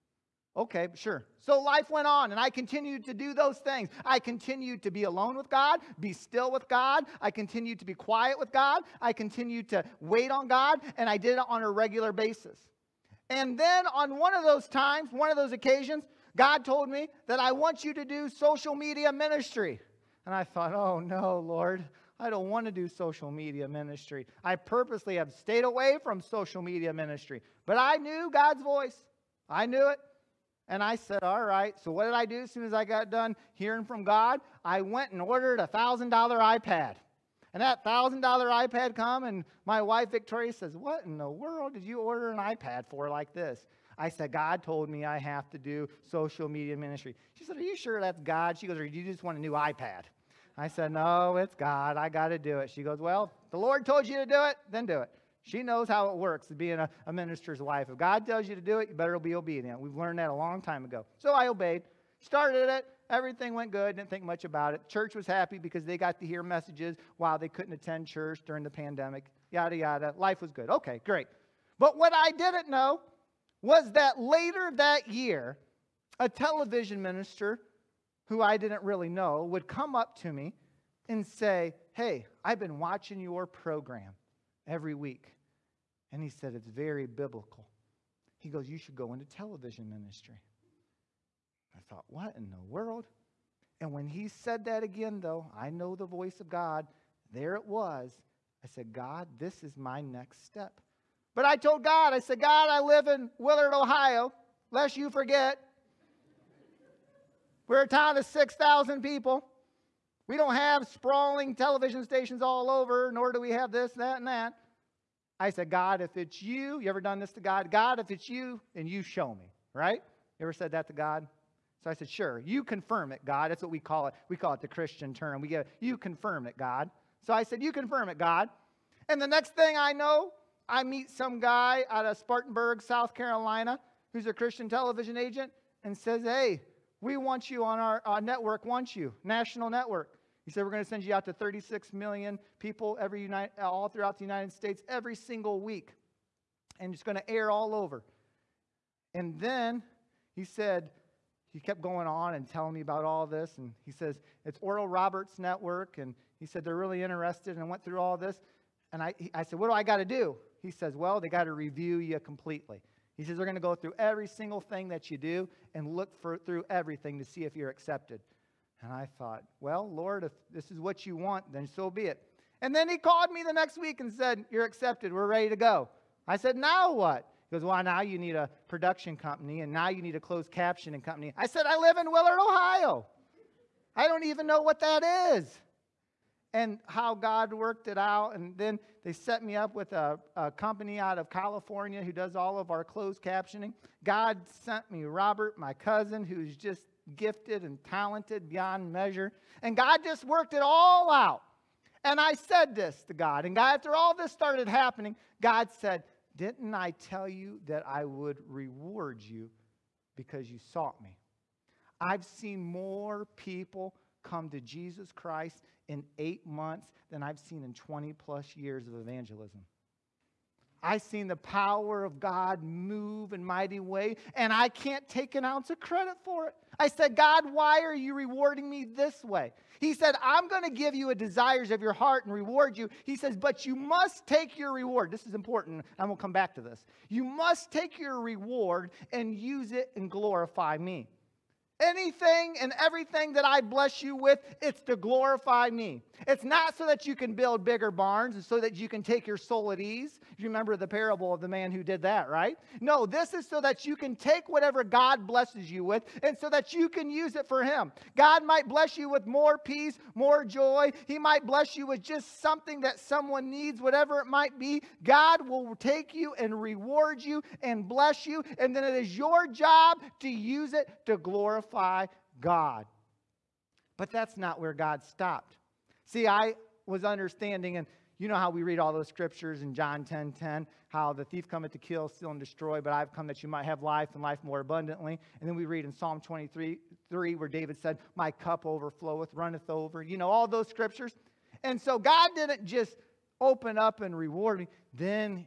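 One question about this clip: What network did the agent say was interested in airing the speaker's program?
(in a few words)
Oral Roberts Network.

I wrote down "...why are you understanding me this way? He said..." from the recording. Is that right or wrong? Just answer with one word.
wrong.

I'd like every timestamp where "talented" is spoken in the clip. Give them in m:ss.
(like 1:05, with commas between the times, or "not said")
3:17.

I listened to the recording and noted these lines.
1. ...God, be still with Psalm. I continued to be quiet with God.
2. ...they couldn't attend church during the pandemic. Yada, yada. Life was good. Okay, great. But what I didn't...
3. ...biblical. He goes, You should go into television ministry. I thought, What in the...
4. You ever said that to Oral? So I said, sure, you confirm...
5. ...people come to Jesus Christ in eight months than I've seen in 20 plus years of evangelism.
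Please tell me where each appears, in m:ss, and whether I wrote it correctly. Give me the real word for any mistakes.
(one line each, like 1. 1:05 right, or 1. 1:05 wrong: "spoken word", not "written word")
1. 0:05 wrong: "God", not "Psalm"
2. 1:07 right
3. 1:27 right
4. 2:00 wrong: "God", not "Oral"
5. 3:33 right.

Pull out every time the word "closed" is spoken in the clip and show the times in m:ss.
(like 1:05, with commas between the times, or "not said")
3:00, 3:12.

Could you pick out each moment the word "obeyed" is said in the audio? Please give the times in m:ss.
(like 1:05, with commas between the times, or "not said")
1:01.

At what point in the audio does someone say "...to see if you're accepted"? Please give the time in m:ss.
2:47.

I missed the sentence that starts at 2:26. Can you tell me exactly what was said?
And it's going to air all over.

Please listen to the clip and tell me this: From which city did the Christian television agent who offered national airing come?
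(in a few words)
Spartanburg, South Carolina.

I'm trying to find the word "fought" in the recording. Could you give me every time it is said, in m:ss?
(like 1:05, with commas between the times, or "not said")
not said.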